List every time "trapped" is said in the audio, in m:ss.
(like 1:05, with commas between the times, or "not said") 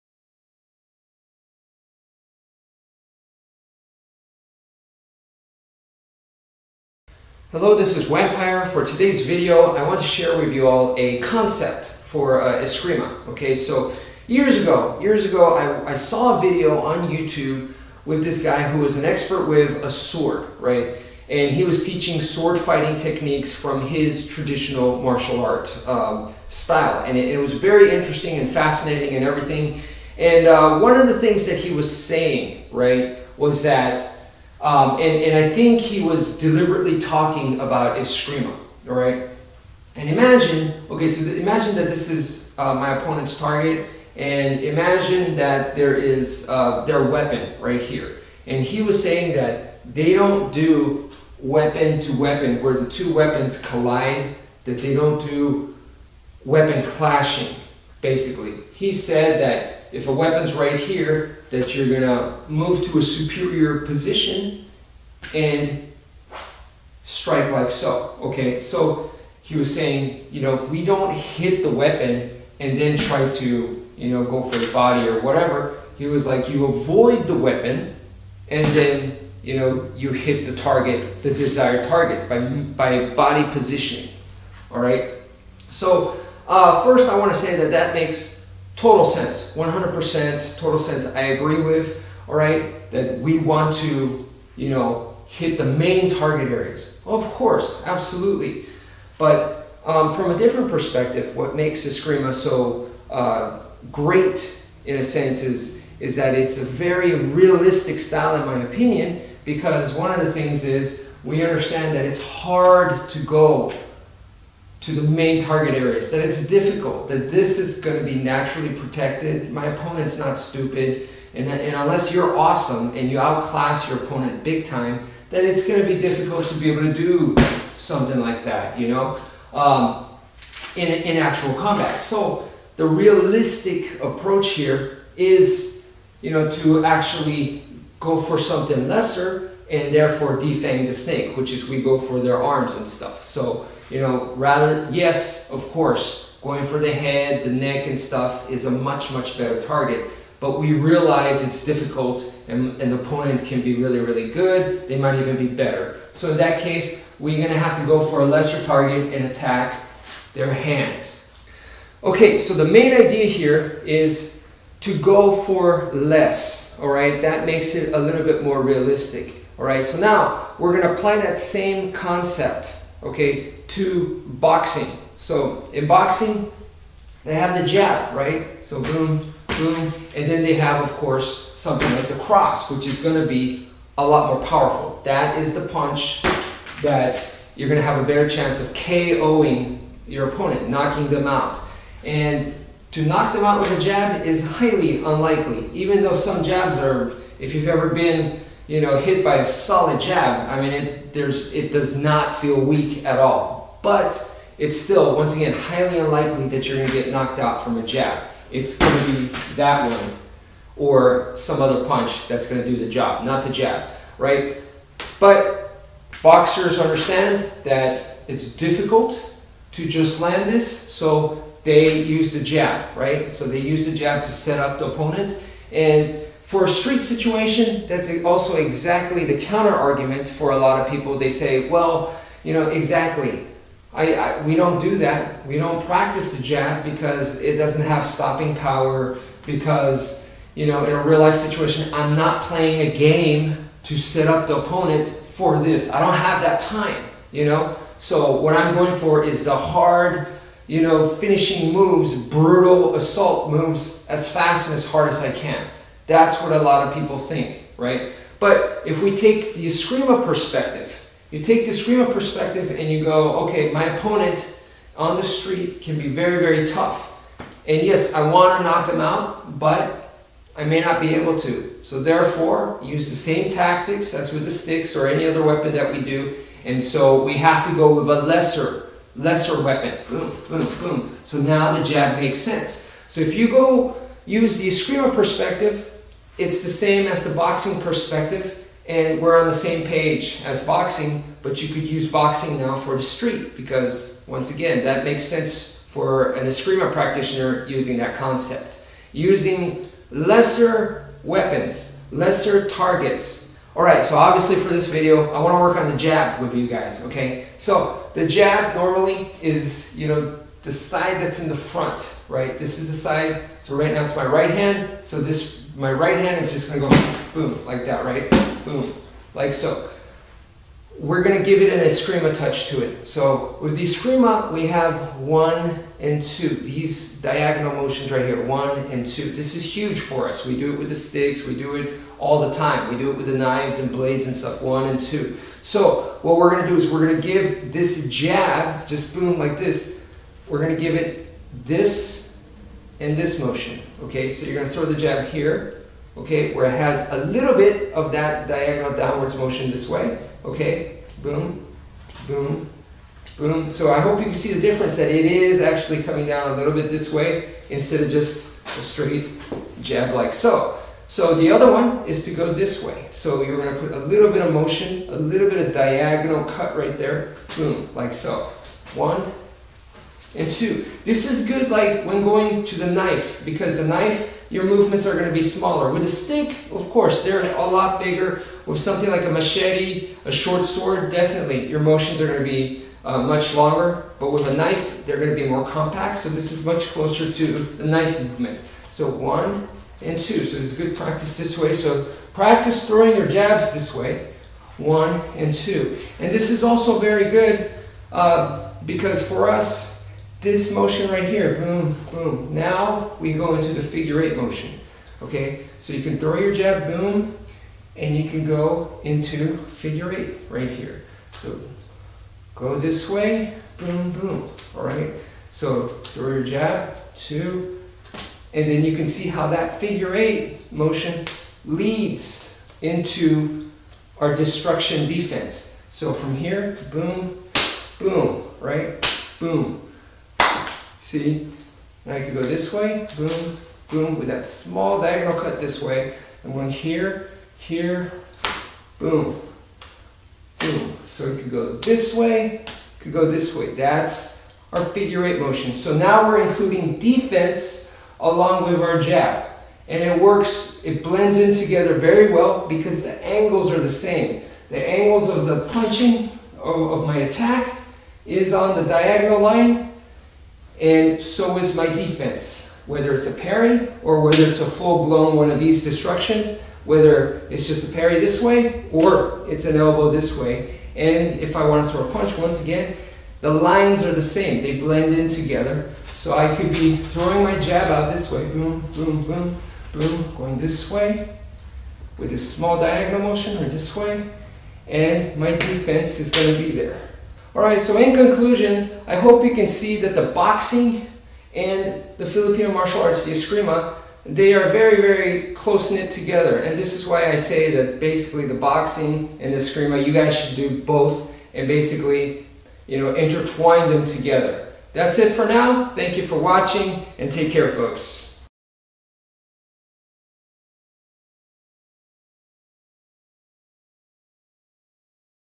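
not said.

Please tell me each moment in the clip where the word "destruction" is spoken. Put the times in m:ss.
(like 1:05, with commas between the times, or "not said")
7:04, 7:45.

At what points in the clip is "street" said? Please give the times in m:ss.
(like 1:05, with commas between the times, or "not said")
3:46, 4:25, 4:53.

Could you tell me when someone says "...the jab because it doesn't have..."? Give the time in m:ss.
3:56.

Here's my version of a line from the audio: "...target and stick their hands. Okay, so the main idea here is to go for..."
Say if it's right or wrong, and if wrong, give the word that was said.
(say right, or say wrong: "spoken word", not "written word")
wrong: "attack", not "stick".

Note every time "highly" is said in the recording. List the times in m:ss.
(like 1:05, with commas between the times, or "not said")
3:14, 3:25.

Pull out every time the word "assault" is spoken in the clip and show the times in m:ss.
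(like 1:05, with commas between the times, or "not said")
4:12.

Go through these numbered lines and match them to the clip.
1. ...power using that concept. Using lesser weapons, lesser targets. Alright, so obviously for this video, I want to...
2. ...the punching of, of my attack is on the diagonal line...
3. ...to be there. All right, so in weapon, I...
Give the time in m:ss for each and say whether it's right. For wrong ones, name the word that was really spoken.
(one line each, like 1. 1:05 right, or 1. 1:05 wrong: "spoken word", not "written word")
1. 4:56 wrong: "practitioner", not "power"
2. 7:35 right
3. 8:06 wrong: "conclusion", not "weapon".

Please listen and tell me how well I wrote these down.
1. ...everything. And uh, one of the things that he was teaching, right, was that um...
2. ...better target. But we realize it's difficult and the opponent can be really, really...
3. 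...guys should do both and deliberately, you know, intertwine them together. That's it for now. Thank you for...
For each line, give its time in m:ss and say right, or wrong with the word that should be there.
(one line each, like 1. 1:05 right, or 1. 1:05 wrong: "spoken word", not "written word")
1. 0:29 wrong: "saying", not "teaching"
2. 2:29 right
3. 8:20 wrong: "basically", not "deliberately".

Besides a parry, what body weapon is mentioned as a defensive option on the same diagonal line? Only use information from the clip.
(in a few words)
elbow.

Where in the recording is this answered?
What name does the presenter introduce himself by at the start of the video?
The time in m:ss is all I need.
0:08.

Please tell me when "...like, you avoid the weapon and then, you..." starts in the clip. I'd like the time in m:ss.
1:16.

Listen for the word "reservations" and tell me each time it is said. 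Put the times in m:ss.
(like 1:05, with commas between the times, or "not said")
not said.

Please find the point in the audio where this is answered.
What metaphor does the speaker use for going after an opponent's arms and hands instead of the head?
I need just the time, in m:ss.
2:20.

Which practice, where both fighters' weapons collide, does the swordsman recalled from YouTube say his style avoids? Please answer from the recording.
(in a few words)
weapon clashing.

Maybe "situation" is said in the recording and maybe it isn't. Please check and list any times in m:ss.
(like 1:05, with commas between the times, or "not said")
3:47, 4:01.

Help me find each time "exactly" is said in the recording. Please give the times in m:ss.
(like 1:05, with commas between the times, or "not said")
3:48, 3:52.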